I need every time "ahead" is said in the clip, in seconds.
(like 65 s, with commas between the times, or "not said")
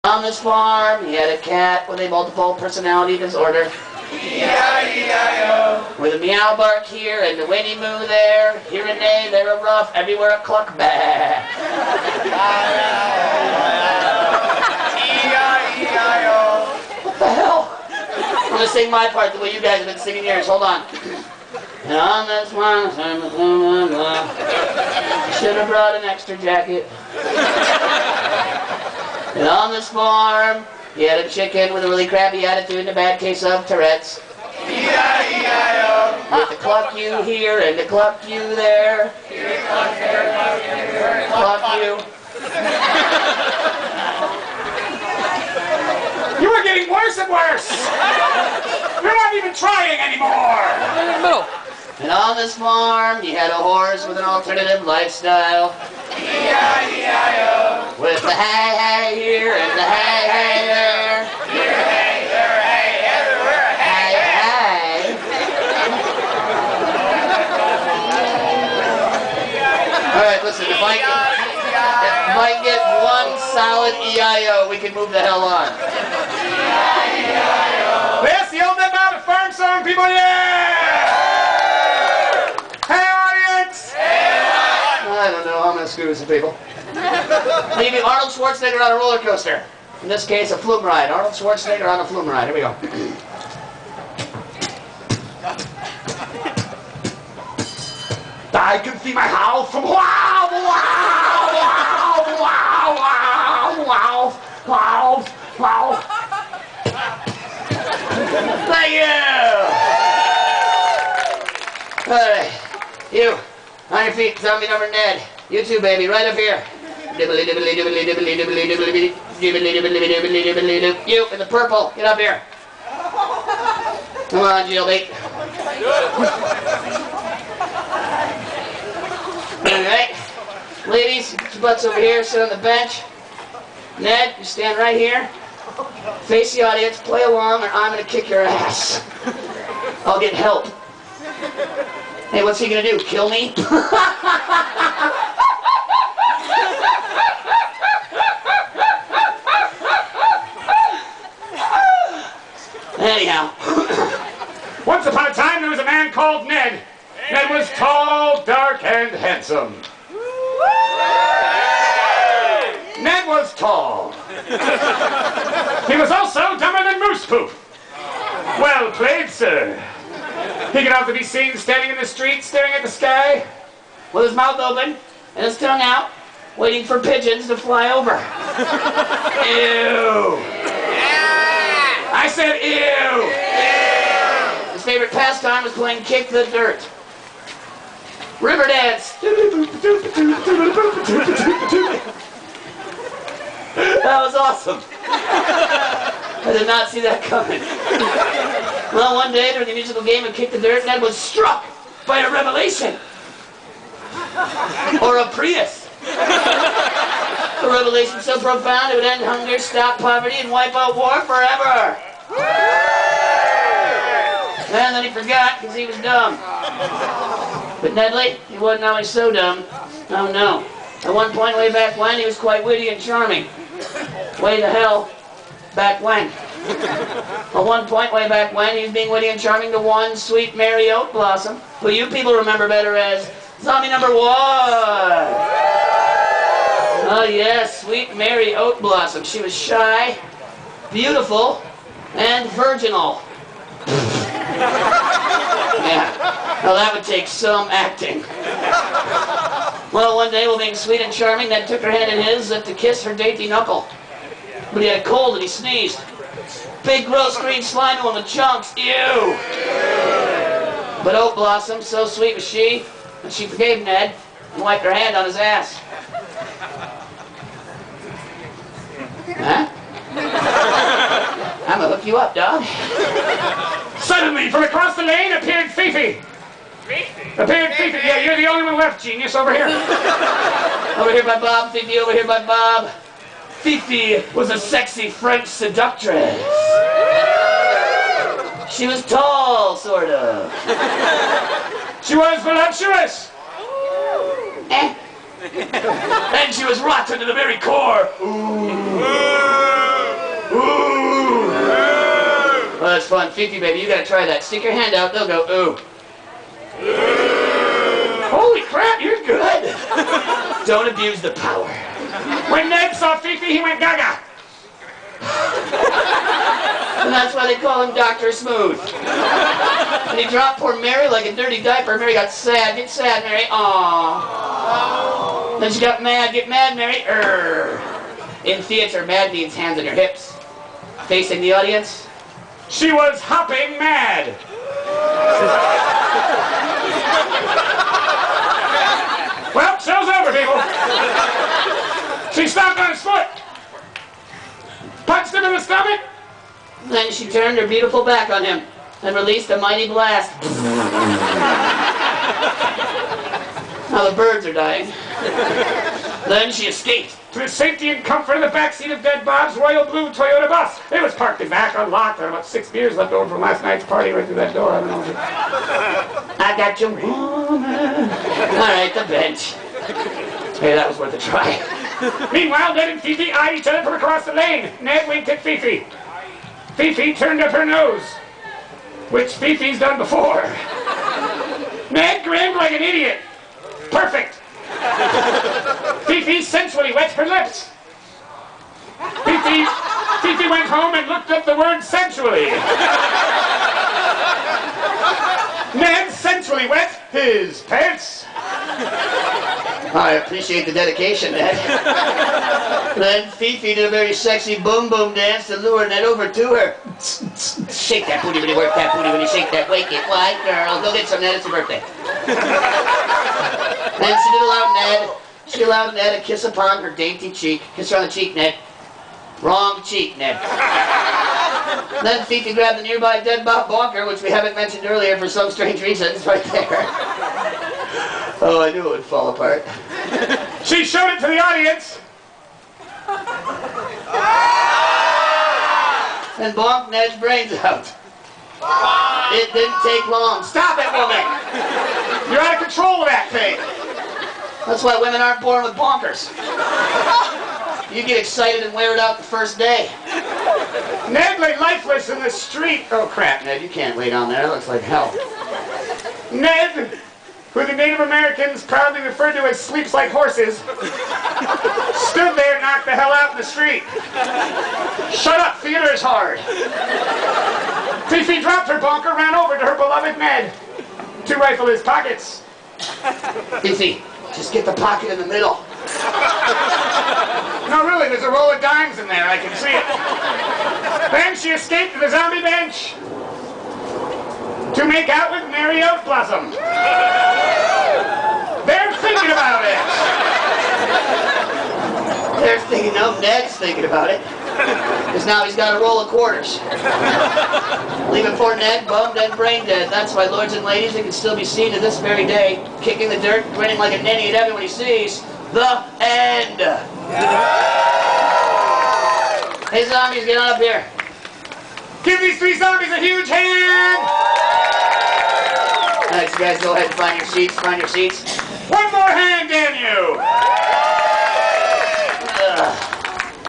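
516 s.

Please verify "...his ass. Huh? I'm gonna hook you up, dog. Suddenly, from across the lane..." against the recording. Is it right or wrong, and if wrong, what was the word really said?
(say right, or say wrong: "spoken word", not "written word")
right.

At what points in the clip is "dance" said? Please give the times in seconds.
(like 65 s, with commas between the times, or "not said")
188 s, 405 s.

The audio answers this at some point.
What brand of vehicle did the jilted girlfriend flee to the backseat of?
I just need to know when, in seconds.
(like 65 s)
360 s.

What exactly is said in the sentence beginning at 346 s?
Then she turned her beautiful back on him and released a mighty blast.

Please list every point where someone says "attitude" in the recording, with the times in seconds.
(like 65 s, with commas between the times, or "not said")
32 s.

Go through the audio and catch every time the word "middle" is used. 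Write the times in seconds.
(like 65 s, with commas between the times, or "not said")
51 s, 475 s.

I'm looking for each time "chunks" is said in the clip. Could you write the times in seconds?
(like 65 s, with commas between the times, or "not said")
258 s.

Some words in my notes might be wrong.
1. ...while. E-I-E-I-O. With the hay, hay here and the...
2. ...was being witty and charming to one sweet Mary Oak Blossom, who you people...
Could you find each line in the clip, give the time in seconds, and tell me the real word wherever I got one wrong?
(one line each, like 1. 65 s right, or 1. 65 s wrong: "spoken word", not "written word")
1. 54 s wrong: "lifestyle", not "while"
2. 228 s right.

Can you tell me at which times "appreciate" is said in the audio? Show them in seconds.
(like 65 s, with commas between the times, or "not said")
400 s.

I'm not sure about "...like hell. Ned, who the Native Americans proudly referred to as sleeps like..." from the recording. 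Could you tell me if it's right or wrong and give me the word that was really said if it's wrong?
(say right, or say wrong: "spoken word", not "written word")
right.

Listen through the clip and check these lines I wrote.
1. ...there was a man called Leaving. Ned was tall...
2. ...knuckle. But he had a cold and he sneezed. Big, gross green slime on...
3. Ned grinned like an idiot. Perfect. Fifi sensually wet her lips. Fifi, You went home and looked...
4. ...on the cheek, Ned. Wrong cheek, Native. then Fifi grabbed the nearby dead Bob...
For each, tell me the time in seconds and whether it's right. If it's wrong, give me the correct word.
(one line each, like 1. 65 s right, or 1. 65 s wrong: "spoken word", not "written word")
1. 155 s wrong: "Ned", not "Leaving"
2. 253 s right
3. 381 s wrong: "Fifi", not "You"
4. 417 s wrong: "Ned", not "Native".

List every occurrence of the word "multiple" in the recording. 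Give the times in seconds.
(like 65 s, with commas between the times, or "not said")
2 s.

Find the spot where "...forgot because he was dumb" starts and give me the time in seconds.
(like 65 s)
215 s.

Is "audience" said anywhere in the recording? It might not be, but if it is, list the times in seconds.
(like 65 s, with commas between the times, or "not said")
136 s, 331 s, 431 s.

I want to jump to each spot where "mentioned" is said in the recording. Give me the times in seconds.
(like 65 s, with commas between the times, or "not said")
424 s.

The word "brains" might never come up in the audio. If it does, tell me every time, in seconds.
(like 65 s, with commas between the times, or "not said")
437 s, 499 s.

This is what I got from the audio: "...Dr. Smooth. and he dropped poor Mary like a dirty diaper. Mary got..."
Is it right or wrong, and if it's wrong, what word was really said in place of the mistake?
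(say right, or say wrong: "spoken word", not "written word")
right.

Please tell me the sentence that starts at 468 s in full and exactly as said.
Fifi dropped her bonker, ran over to her beloved Ned, to rifle his pockets.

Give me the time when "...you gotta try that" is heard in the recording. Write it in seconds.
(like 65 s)
303 s.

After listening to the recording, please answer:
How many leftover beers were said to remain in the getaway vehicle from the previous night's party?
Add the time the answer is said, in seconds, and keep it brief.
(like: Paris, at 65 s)
6, at 362 s.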